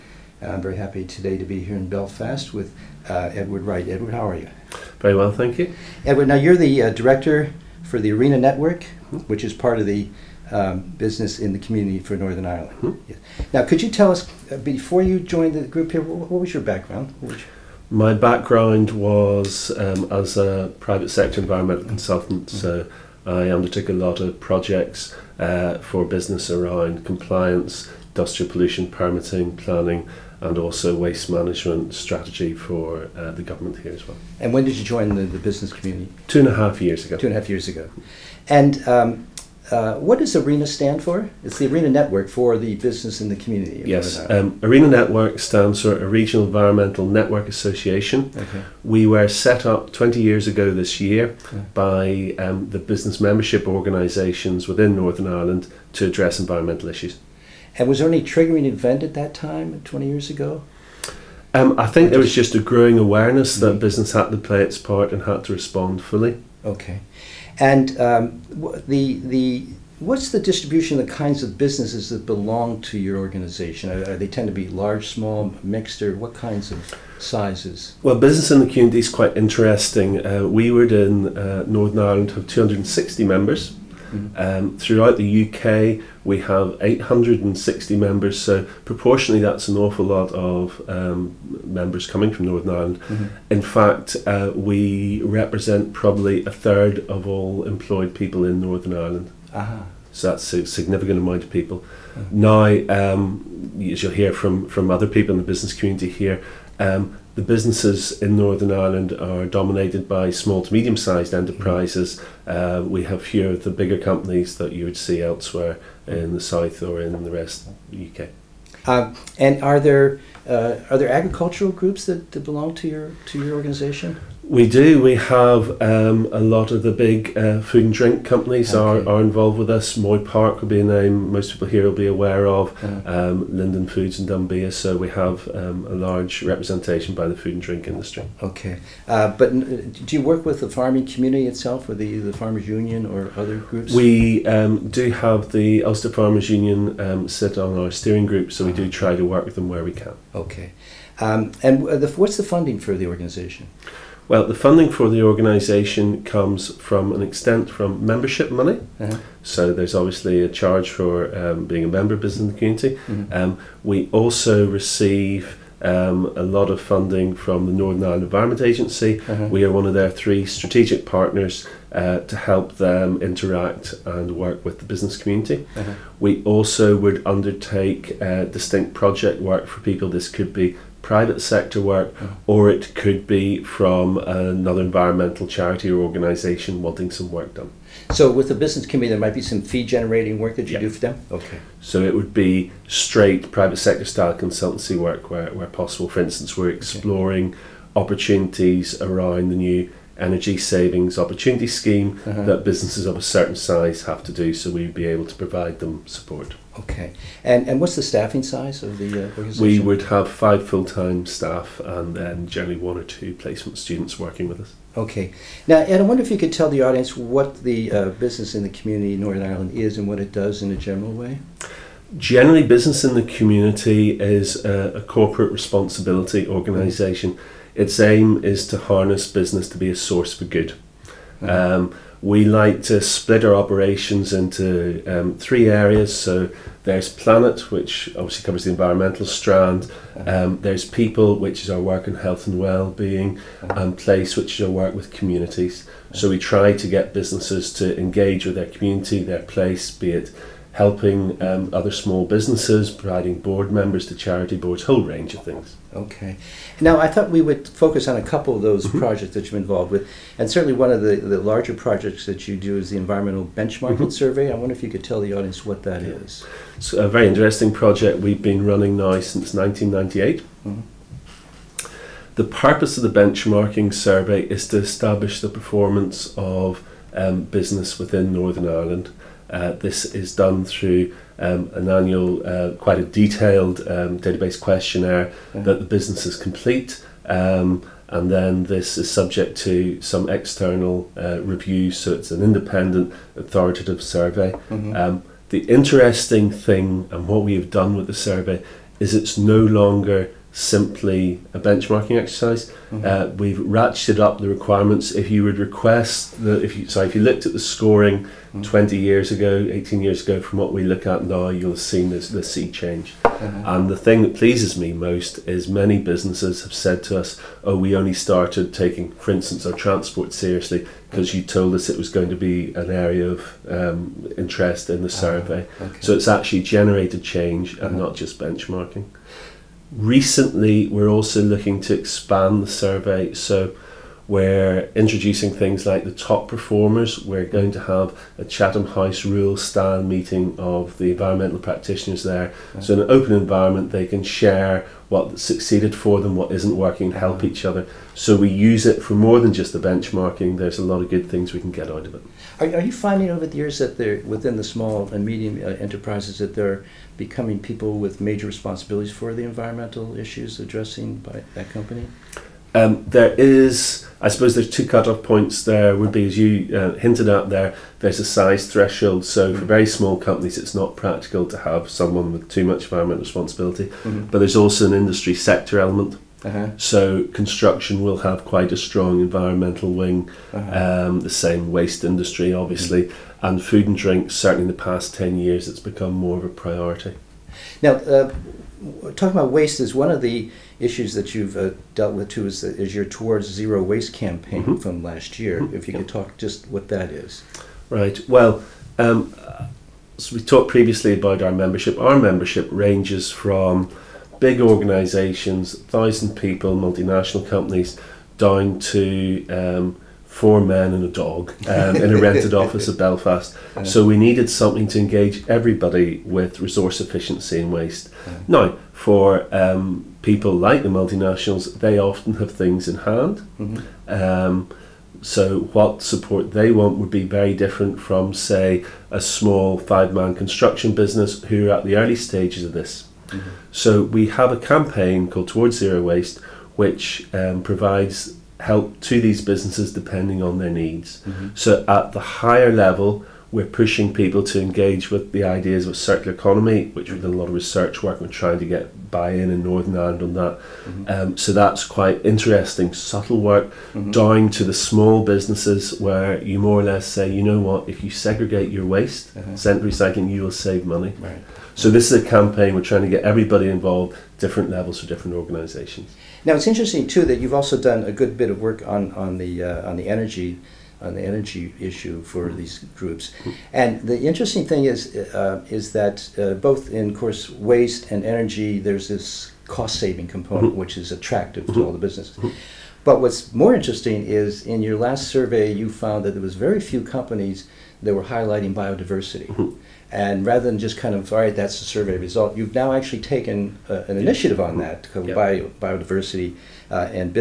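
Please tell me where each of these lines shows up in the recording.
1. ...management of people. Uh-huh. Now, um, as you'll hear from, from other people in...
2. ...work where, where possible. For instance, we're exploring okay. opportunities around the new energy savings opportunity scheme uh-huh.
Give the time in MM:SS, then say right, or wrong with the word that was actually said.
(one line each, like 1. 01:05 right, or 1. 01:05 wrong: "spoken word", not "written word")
1. 01:41 wrong: "amount", not "management"
2. 03:14 right.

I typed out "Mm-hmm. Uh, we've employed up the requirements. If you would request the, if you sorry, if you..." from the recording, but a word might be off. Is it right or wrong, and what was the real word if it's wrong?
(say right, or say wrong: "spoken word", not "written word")
wrong: "ratcheted", not "employed".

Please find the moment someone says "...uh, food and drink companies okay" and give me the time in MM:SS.
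02:07.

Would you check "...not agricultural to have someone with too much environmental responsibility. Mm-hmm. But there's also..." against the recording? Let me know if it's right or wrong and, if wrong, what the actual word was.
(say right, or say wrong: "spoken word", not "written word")
wrong: "practical", not "agricultural".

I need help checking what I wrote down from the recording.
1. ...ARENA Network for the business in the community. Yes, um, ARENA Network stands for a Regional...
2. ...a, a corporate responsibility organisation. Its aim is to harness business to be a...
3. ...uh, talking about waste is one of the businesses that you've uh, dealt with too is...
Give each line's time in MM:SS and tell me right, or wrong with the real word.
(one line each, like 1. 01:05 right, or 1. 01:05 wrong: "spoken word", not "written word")
1. 00:41 right
2. 03:44 right
3. 06:27 wrong: "issues", not "businesses".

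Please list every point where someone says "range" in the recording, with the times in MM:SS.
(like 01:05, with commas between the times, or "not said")
04:15, 06:42.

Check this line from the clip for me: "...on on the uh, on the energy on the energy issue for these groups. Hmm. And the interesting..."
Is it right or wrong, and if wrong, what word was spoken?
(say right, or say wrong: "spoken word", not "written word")
right.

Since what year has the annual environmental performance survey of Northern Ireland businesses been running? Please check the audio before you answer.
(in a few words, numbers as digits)
1998.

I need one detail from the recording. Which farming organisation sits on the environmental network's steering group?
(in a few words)
Ulster Farmers Union.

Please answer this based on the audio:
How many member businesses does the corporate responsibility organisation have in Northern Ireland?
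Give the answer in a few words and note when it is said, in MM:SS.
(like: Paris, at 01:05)
260, at 01:22.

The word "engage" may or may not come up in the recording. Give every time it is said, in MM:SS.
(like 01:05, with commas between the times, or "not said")
04:07, 06:54, 07:24.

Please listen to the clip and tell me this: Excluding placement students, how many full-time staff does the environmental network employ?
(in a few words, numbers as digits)
5.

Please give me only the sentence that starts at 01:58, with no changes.
Um, and are there uh, are there agricultural groups that, that belong to your to your organization?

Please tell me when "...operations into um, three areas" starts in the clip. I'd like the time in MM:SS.
03:53.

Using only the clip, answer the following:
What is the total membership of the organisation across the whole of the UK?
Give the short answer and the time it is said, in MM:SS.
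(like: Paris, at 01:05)
860, at 01:26.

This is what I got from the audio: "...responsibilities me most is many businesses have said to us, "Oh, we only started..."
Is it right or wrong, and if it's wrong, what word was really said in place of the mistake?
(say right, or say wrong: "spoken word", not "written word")
wrong: "pleases", not "responsibilities".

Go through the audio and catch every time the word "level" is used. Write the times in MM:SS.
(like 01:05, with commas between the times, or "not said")
07:22, 07:44.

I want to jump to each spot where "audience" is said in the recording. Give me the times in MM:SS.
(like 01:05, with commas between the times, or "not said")
03:36, 04:25.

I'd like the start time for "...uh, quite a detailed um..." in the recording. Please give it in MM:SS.
04:42.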